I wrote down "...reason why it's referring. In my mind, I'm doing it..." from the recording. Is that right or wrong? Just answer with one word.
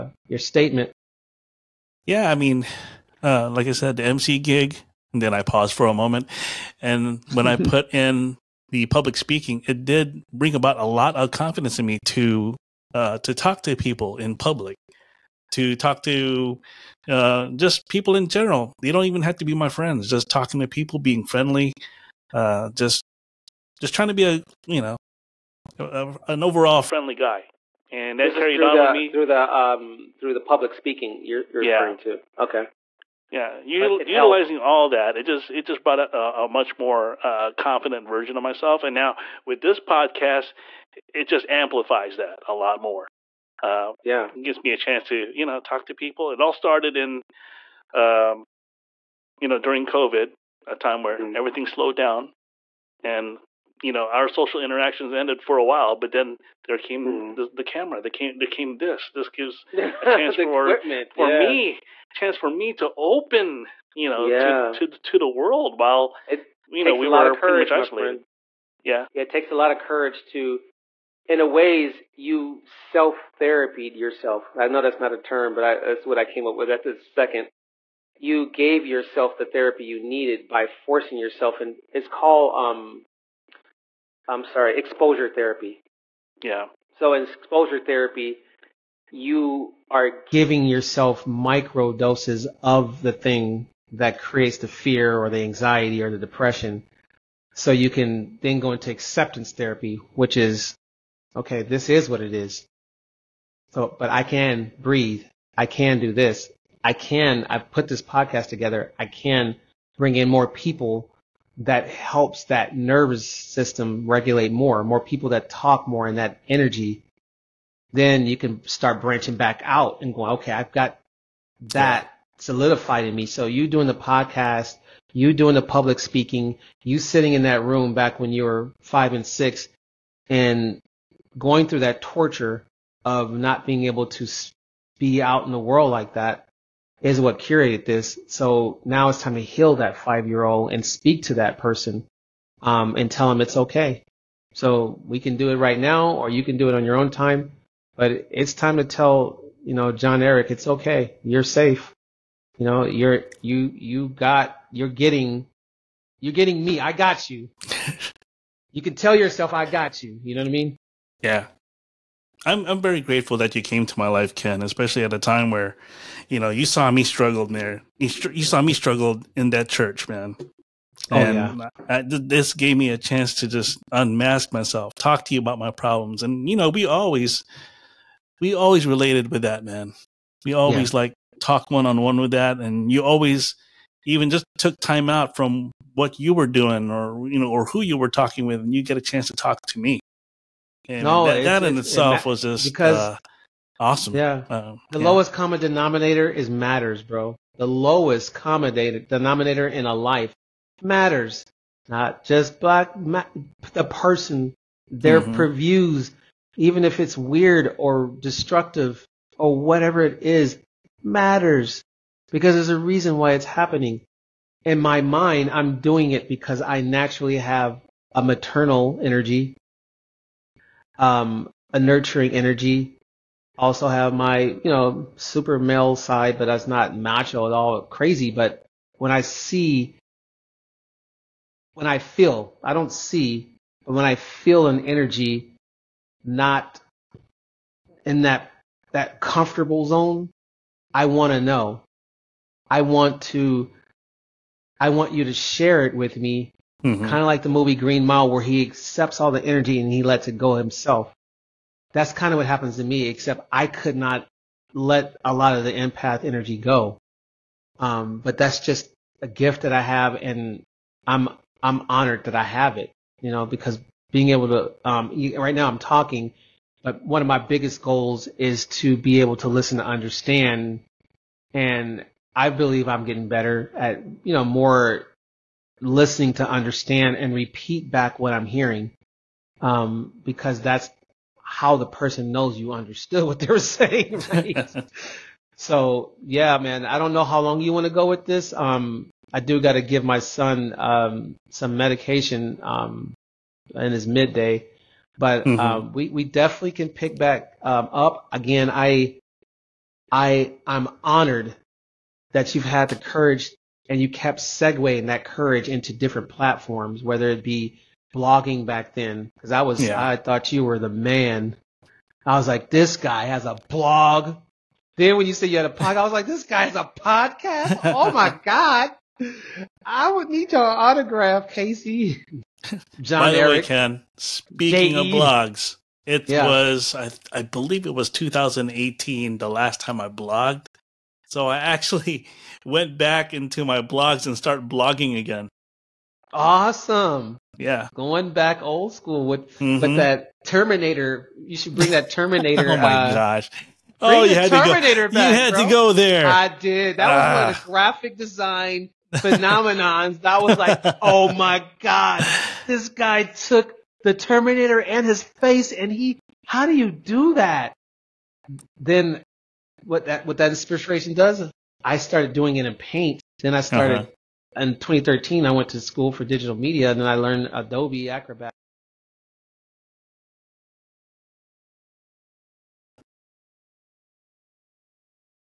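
wrong.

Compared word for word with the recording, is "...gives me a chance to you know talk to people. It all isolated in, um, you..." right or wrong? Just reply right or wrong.
wrong.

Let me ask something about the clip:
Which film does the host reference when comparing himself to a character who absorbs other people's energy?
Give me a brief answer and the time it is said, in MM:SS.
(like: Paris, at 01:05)
Green Mile, at 04:07.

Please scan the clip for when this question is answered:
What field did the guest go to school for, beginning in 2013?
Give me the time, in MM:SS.
06:06.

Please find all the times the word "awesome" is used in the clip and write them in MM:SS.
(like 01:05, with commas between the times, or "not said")
03:13, 05:36.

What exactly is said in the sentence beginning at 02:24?
So we can do it right now, or you can do it on your own time.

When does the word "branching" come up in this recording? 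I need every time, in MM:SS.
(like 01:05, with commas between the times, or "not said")
01:59.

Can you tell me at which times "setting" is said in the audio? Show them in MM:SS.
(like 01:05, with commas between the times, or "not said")
not said.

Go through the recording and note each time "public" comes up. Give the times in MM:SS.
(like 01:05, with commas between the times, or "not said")
00:08, 00:14, 00:30, 02:05.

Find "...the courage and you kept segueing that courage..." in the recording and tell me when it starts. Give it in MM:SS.
05:02.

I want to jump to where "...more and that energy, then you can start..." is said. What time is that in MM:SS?
01:55.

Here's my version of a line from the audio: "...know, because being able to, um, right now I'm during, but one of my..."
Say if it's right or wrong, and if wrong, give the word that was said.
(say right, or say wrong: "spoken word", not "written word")
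wrong: "talking", not "during".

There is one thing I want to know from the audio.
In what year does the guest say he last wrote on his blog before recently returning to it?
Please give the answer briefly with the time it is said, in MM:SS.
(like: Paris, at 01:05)
2018, at 05:28.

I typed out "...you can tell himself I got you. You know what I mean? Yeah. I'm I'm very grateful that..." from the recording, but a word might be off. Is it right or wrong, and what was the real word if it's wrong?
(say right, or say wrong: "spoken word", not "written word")
wrong: "yourself", not "himself".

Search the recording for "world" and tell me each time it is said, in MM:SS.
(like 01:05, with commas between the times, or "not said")
01:05, 02:15.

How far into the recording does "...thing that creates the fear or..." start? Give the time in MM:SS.
01:33.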